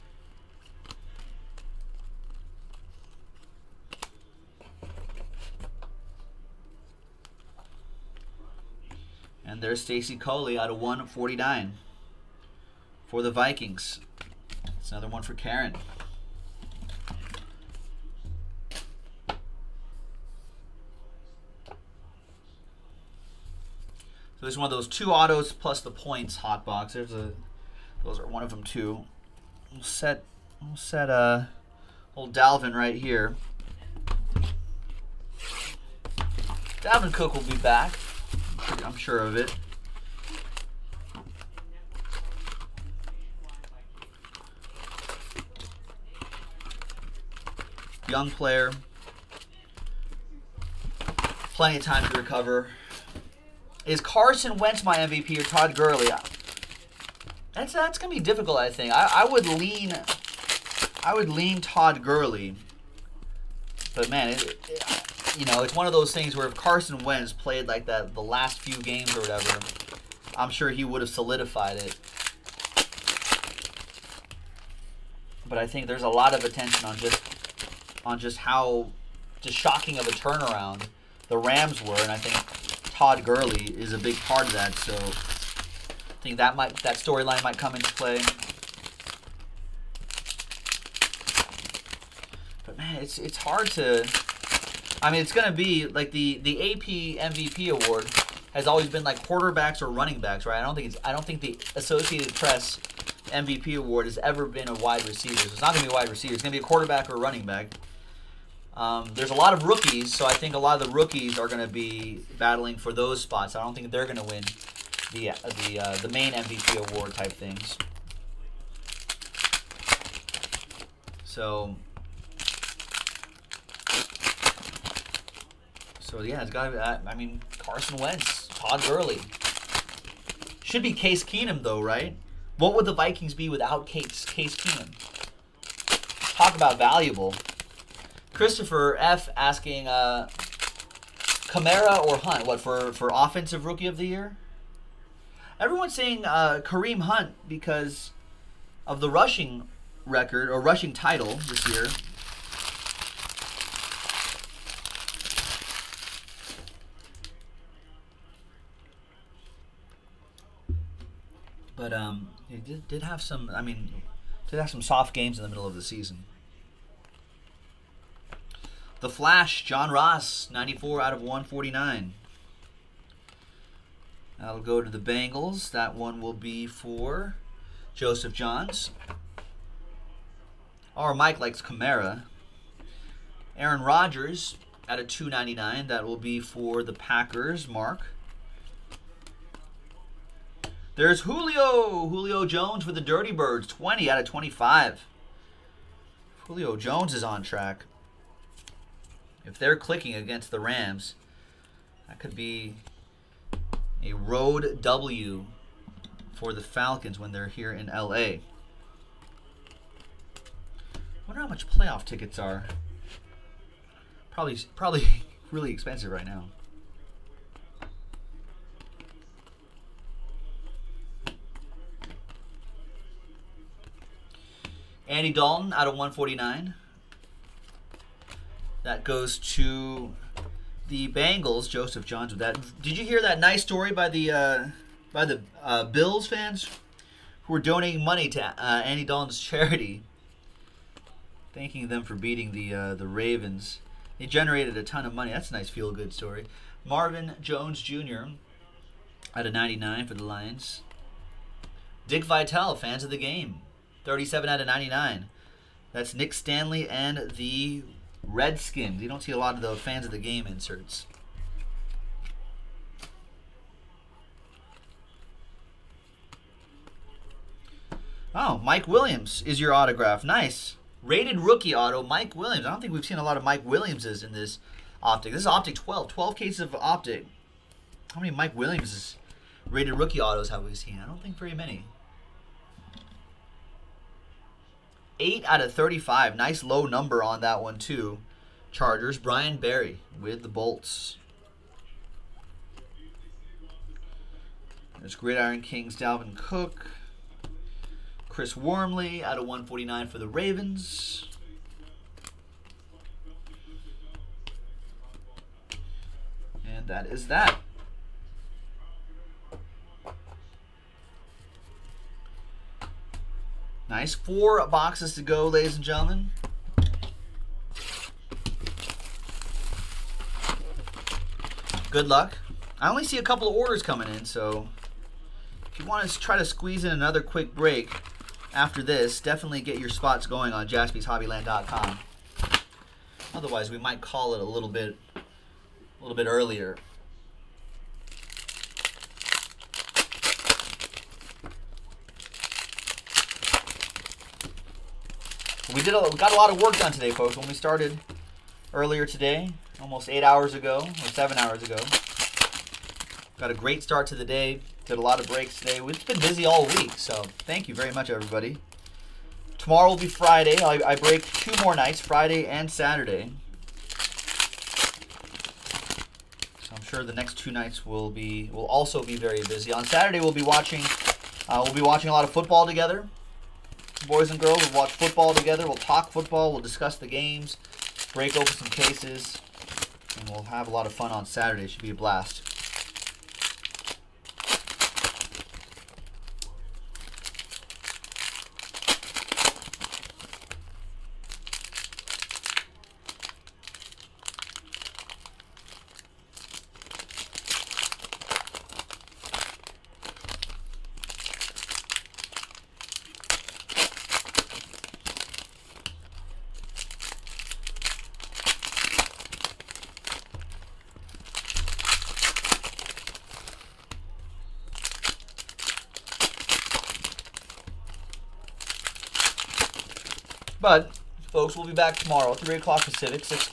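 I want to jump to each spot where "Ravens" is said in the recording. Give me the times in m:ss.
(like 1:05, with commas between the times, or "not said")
4:03, 5:00.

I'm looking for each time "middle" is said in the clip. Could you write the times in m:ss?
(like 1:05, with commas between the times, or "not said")
2:45.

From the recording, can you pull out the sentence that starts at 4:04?
They generated a ton of money.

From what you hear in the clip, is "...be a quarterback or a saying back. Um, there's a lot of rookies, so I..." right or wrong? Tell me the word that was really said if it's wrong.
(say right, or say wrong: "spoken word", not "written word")
wrong: "running", not "saying".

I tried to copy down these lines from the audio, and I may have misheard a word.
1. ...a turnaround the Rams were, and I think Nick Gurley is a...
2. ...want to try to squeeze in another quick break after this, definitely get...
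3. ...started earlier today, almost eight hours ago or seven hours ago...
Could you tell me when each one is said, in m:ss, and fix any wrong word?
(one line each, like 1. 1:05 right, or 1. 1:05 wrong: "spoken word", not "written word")
1. 1:20 wrong: "Todd", not "Nick"
2. 5:25 right
3. 5:47 right.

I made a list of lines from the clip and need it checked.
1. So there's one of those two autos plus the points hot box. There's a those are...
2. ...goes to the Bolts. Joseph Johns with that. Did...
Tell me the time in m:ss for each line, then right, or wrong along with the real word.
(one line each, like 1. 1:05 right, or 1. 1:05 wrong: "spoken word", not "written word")
1. 0:17 right
2. 3:49 wrong: "Bengals", not "Bolts".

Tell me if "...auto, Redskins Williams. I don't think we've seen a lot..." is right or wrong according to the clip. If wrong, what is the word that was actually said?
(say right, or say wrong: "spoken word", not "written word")
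wrong: "Mike", not "Redskins".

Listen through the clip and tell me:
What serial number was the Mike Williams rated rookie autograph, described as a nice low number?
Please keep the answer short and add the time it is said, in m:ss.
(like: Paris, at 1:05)
8 out of 35, at 4:45.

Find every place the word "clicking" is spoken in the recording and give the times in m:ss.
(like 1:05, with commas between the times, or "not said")
3:19.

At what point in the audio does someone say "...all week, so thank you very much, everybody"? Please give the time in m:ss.
5:56.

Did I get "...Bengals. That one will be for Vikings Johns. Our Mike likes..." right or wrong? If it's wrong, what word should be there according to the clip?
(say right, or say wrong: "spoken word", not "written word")
wrong: "Joseph", not "Vikings".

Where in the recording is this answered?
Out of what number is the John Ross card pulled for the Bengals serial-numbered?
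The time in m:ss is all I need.
2:50.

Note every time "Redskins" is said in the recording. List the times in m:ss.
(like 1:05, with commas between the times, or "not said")
4:18.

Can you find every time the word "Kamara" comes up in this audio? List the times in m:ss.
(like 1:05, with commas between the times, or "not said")
2:21, 3:01.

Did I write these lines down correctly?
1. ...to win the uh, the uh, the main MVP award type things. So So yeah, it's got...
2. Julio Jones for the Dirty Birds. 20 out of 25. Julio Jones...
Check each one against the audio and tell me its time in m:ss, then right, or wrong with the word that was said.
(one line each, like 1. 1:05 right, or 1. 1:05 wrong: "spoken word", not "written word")
1. 1:54 right
2. 3:12 right.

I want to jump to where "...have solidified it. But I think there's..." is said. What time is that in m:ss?
1:10.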